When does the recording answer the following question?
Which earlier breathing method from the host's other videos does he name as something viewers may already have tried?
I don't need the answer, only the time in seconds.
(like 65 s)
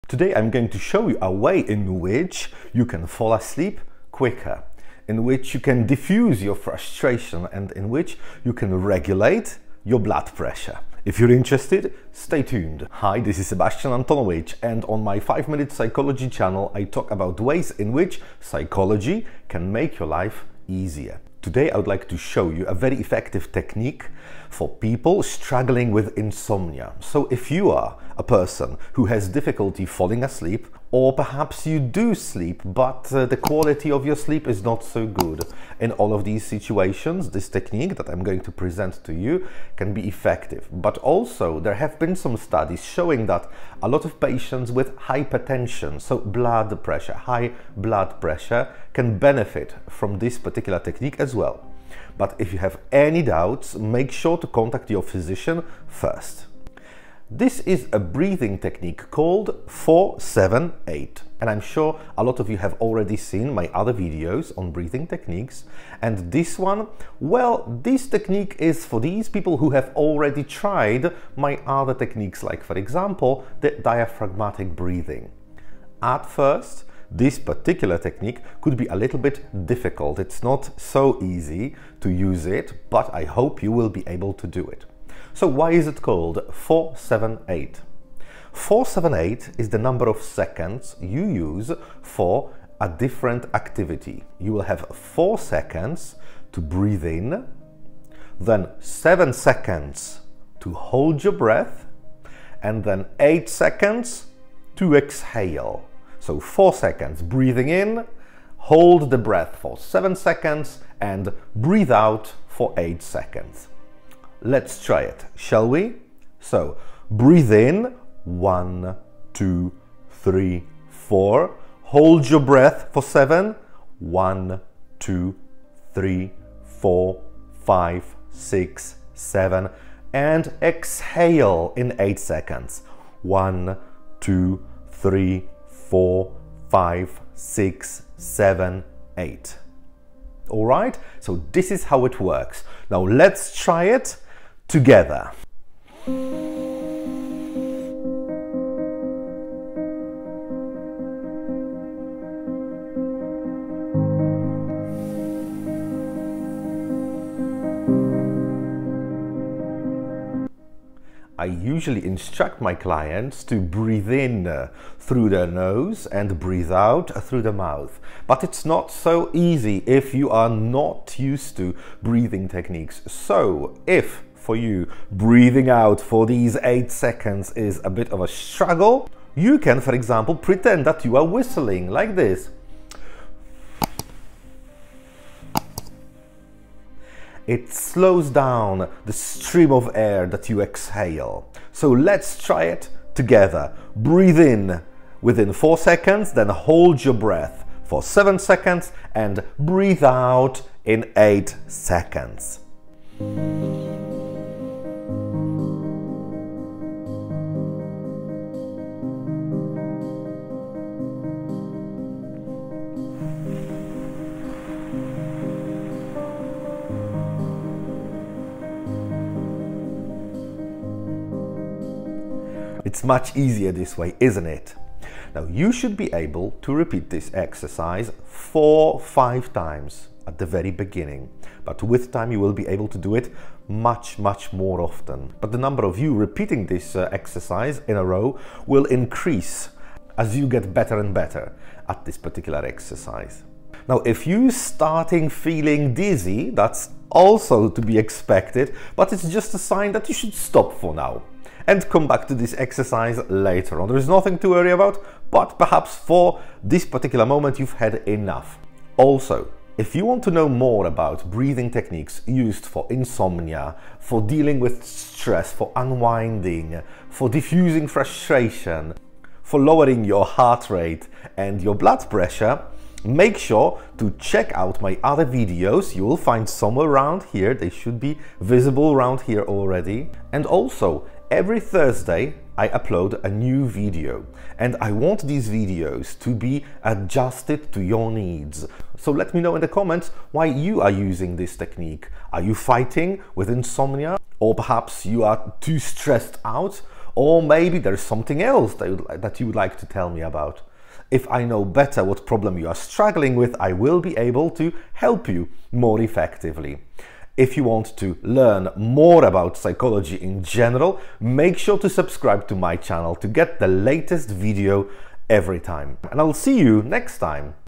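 73 s.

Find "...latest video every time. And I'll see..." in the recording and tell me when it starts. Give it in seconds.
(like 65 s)
313 s.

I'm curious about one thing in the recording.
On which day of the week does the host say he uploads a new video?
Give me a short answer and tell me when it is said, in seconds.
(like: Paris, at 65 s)
Thursday, at 281 s.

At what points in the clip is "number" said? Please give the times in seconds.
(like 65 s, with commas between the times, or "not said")
89 s, 235 s.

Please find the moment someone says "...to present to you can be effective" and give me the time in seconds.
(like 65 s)
38 s.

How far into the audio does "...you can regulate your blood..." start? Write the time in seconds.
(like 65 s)
8 s.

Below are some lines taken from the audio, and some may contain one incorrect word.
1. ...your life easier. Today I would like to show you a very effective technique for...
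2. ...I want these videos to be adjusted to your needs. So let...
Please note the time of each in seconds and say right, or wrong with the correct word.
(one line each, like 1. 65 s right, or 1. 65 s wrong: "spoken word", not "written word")
1. 19 s right
2. 284 s right.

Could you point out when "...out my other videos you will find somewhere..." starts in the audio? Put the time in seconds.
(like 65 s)
274 s.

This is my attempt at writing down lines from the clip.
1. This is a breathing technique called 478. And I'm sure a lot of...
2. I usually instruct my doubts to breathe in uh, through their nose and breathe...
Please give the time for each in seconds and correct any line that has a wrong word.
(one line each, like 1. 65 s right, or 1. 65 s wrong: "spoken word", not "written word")
1. 57 s right
2. 161 s wrong: "clients", not "doubts".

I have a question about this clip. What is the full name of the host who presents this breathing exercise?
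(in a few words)
Sebastian Antonovich.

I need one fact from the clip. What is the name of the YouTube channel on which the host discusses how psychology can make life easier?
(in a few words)
5 Minute Psychology.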